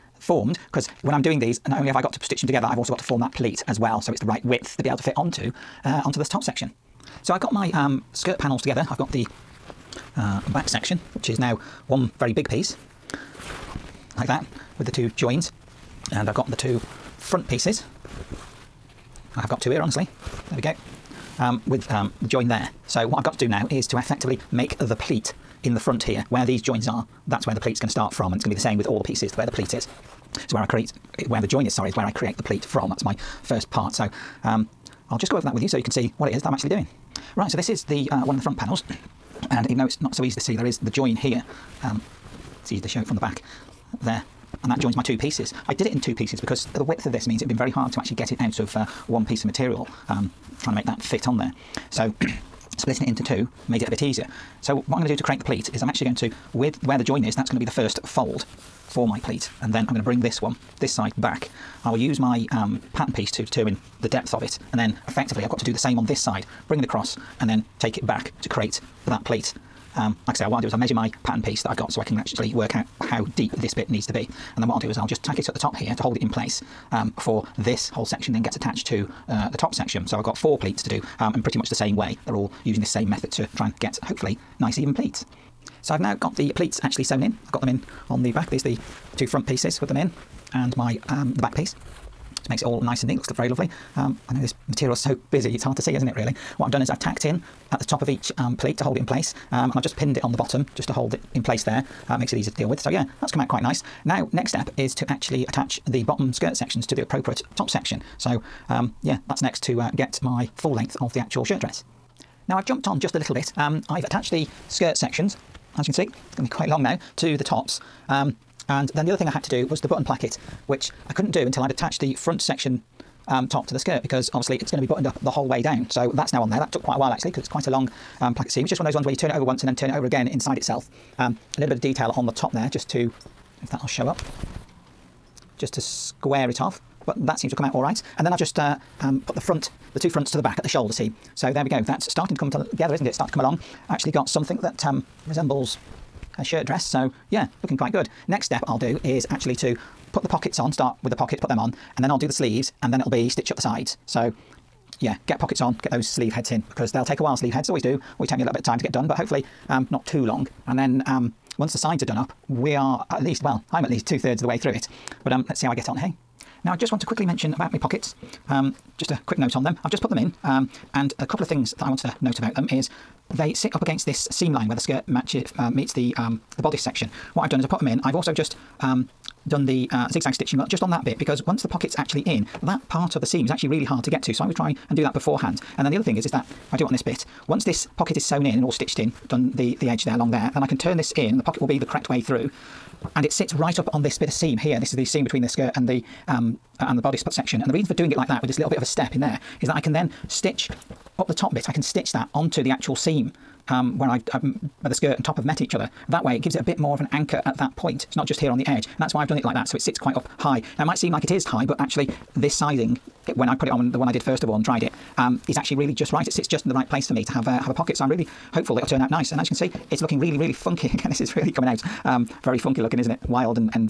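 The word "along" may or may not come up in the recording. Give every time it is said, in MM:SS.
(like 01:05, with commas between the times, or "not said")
02:23, 03:10.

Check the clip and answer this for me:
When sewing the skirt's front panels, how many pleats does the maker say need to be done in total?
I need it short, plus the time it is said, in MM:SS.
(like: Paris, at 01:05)
4, at 01:20.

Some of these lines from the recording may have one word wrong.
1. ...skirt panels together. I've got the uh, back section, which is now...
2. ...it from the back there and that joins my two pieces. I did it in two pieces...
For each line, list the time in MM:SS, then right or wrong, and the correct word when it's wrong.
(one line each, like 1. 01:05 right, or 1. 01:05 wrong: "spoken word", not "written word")
1. 00:08 right
2. 00:42 right.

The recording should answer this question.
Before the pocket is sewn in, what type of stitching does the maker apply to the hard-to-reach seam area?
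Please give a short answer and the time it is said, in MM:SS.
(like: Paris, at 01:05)
Zigzag stitching, at 03:00.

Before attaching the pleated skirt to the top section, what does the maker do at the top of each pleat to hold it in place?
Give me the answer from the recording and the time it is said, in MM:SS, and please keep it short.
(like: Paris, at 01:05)
Tack it, at 01:36.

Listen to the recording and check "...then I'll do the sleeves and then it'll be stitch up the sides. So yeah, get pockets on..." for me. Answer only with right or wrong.
right.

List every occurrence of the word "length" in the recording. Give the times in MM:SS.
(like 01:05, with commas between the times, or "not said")
01:50.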